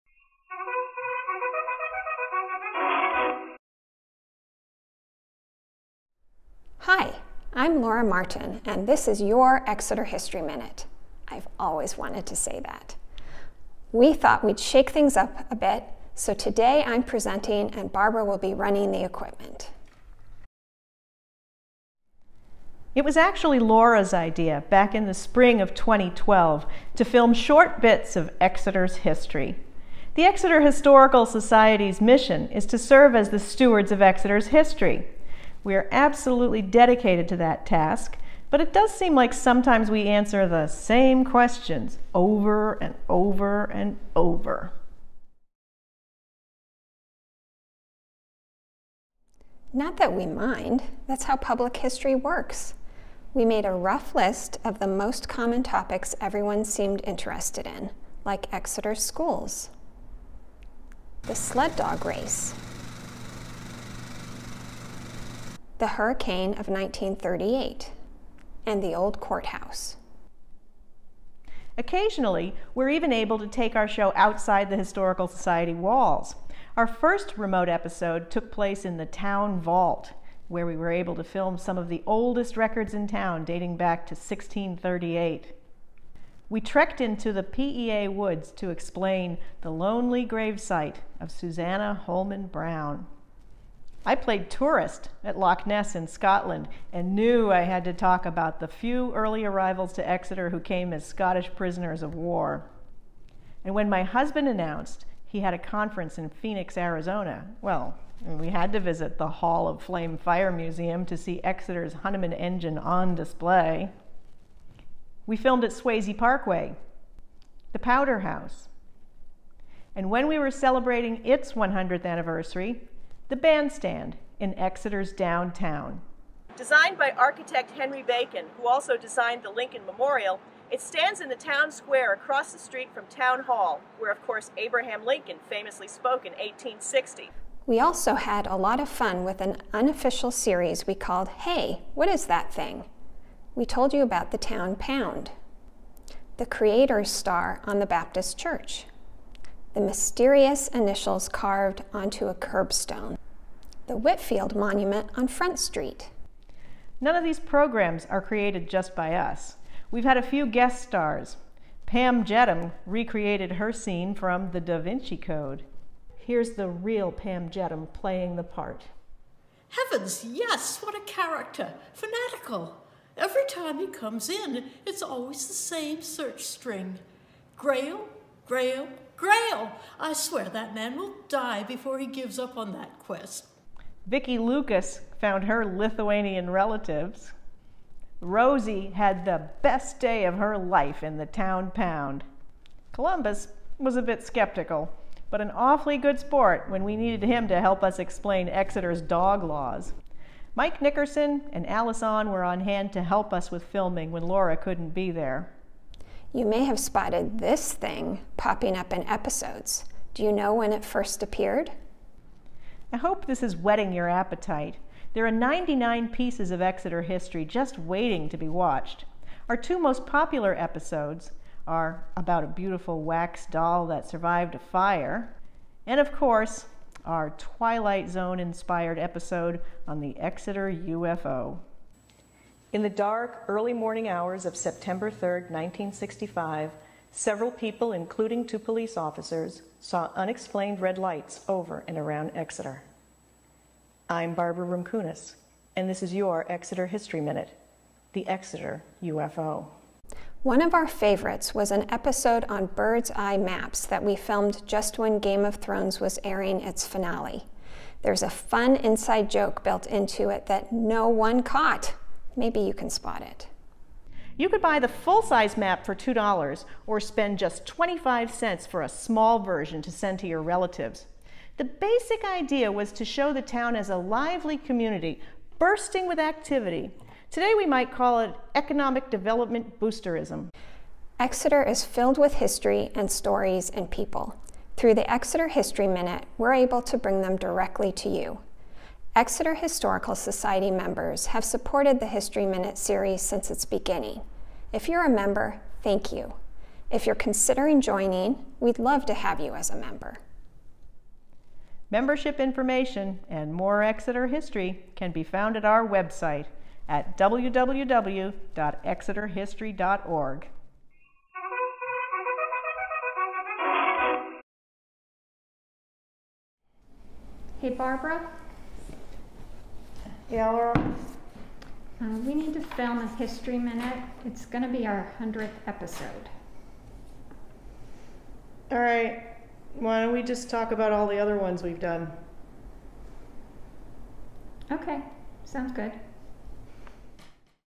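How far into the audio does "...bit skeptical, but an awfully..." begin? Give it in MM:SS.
03:14.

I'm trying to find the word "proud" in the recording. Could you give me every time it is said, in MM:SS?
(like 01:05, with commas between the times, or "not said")
not said.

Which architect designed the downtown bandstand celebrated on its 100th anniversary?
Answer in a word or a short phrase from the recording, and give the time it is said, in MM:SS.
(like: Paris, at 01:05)
Henry Bacon, at 02:07.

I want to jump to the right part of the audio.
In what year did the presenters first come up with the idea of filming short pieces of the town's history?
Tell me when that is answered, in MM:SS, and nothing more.
00:25.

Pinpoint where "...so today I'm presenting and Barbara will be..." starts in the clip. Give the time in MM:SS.
00:16.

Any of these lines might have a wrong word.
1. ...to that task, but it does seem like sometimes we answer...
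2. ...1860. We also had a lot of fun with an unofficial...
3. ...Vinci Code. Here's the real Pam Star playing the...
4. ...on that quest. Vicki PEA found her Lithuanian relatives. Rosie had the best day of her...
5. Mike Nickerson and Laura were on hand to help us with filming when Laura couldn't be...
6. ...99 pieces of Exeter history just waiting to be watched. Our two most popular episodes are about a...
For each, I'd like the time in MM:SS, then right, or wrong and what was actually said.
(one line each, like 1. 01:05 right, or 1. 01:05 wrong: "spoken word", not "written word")
1. 00:37 right
2. 02:16 right
3. 02:44 wrong: "Jedham", not "Star"
4. 03:02 wrong: "Lucas", not "PEA"
5. 03:20 wrong: "Allison", not "Laura"
6. 03:35 right.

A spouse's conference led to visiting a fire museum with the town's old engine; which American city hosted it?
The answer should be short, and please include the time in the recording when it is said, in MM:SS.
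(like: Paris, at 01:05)
Phoenix, Arizona, at 01:46.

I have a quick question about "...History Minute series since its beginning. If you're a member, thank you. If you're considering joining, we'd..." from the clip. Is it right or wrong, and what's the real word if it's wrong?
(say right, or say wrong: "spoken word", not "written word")
right.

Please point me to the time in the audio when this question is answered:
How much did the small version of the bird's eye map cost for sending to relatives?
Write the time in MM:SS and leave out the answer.
04:27.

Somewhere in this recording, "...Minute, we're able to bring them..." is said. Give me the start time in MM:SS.
04:45.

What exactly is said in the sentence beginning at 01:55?
We filmed at Swasey Parkway, the Powder House.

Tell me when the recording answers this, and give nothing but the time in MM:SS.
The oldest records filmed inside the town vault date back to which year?
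01:24.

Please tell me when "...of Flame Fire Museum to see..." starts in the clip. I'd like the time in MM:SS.
01:49.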